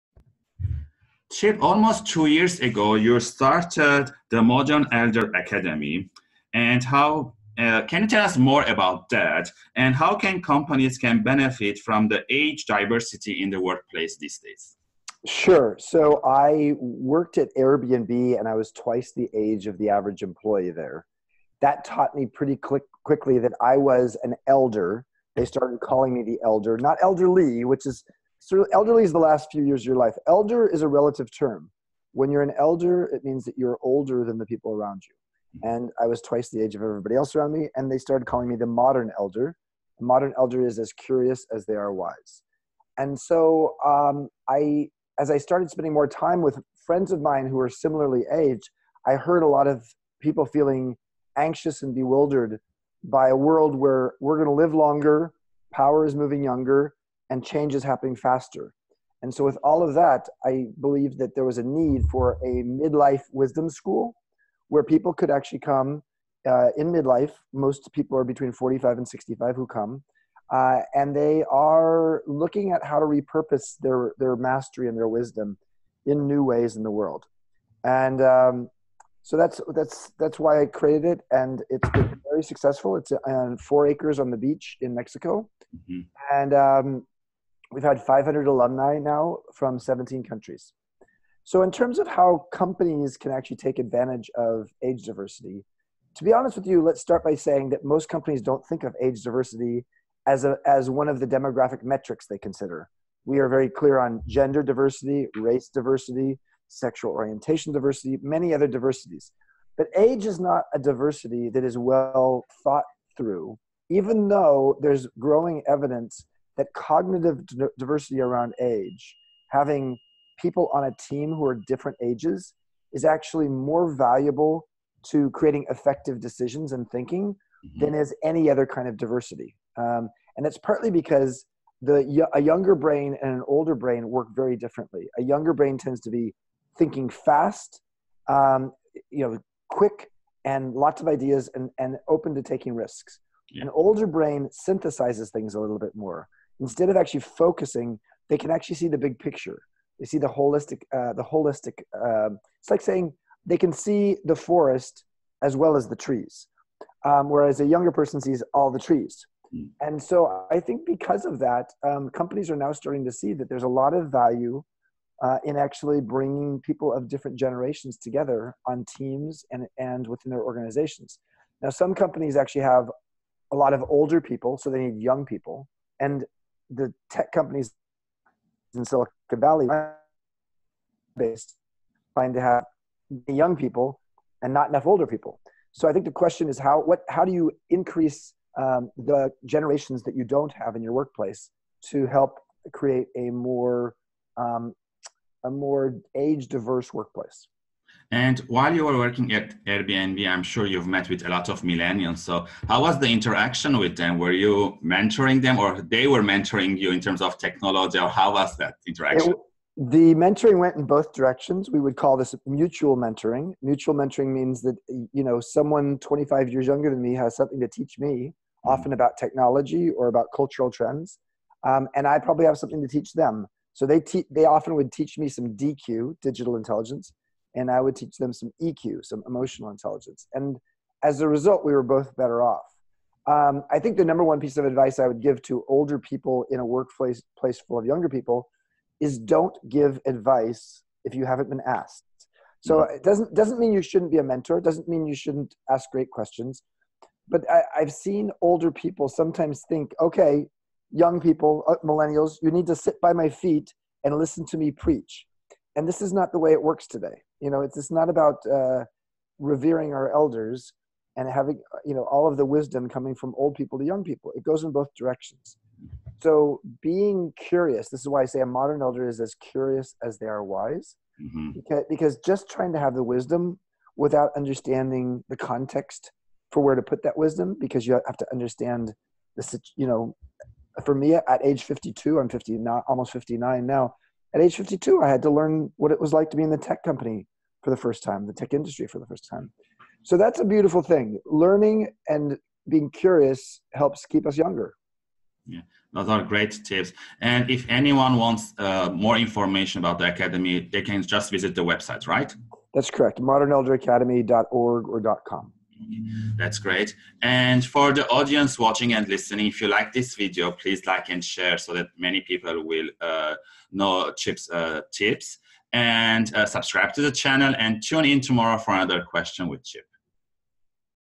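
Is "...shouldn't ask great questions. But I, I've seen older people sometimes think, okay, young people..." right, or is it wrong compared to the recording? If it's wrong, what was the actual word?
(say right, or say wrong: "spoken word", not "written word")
right.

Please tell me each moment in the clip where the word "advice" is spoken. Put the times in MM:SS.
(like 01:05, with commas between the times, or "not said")
03:54, 04:00.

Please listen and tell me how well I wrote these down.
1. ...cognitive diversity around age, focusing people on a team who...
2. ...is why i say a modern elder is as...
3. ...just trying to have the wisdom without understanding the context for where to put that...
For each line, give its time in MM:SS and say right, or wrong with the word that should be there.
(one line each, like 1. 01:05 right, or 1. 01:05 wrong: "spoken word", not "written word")
1. 01:56 wrong: "having", not "focusing"
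2. 04:27 right
3. 04:32 right.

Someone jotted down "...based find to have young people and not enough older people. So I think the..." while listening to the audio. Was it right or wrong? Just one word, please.
right.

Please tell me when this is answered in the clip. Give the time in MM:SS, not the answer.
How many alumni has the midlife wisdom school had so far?
01:28.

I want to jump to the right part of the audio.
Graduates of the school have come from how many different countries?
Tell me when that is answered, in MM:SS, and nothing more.
01:29.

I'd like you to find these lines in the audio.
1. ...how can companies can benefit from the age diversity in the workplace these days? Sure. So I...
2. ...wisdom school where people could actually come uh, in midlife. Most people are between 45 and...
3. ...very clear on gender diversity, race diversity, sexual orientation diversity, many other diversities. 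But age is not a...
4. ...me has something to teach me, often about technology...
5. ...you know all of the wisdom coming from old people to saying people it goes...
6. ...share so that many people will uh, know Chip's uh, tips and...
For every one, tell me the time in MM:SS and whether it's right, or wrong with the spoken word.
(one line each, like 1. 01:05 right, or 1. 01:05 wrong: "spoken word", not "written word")
1. 00:09 right
2. 01:03 right
3. 01:43 right
4. 03:37 right
5. 04:21 wrong: "young", not "saying"
6. 05:11 right.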